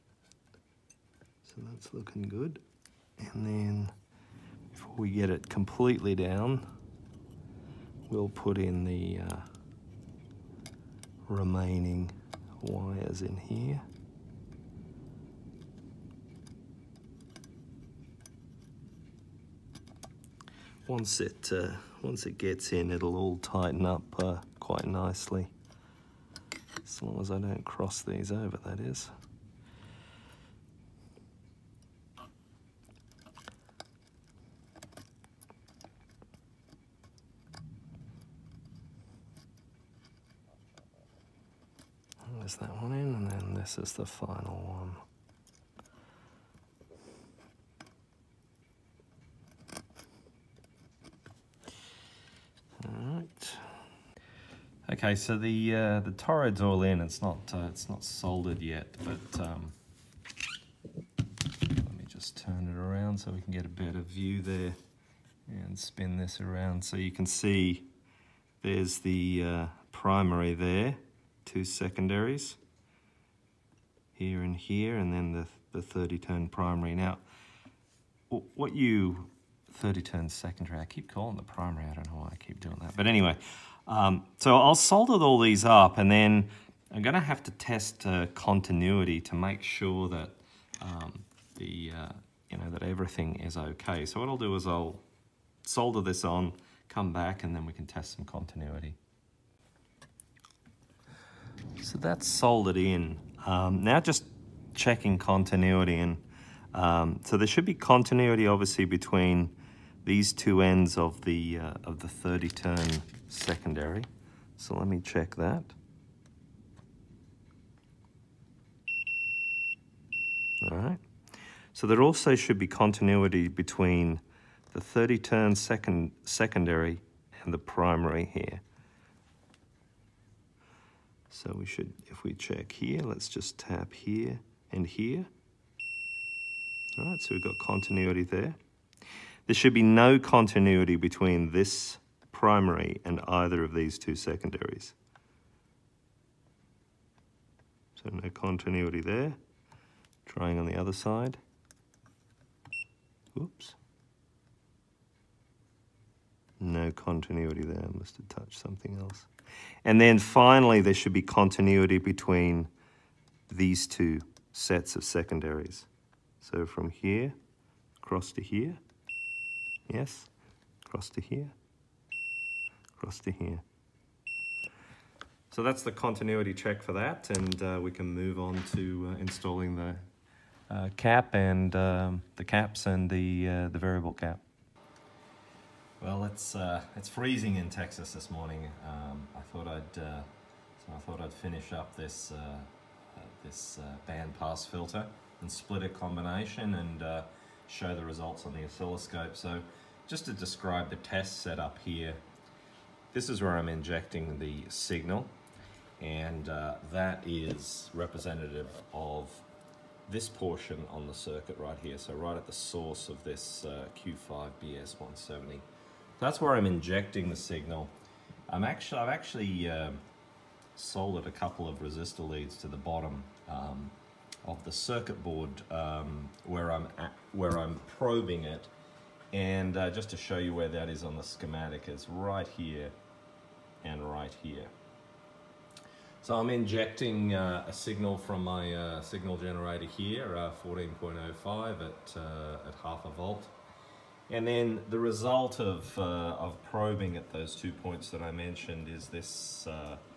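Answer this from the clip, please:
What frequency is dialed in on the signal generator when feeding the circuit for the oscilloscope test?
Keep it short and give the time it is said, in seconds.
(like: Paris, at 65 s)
14.05, at 240 s.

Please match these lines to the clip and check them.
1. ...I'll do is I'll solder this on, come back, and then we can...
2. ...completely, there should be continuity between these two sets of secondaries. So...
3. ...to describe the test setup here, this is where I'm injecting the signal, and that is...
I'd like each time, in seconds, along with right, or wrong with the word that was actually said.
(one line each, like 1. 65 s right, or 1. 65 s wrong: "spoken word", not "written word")
1. 94 s right
2. 160 s wrong: "finally", not "completely"
3. 200 s right.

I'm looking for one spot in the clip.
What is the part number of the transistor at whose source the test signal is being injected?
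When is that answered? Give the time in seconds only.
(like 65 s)
213 s.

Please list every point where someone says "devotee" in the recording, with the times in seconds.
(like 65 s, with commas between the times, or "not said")
not said.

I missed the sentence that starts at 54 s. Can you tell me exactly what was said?
Okay, so the uh, the toroid's all in.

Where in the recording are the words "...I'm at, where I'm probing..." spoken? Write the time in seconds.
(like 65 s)
226 s.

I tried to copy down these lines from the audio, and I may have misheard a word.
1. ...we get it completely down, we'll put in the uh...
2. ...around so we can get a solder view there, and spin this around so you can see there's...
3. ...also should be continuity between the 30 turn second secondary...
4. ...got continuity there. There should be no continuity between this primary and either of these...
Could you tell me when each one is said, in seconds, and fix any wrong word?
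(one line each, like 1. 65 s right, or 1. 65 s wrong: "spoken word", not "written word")
1. 4 s right
2. 62 s wrong: "better", not "solder"
3. 122 s right
4. 137 s right.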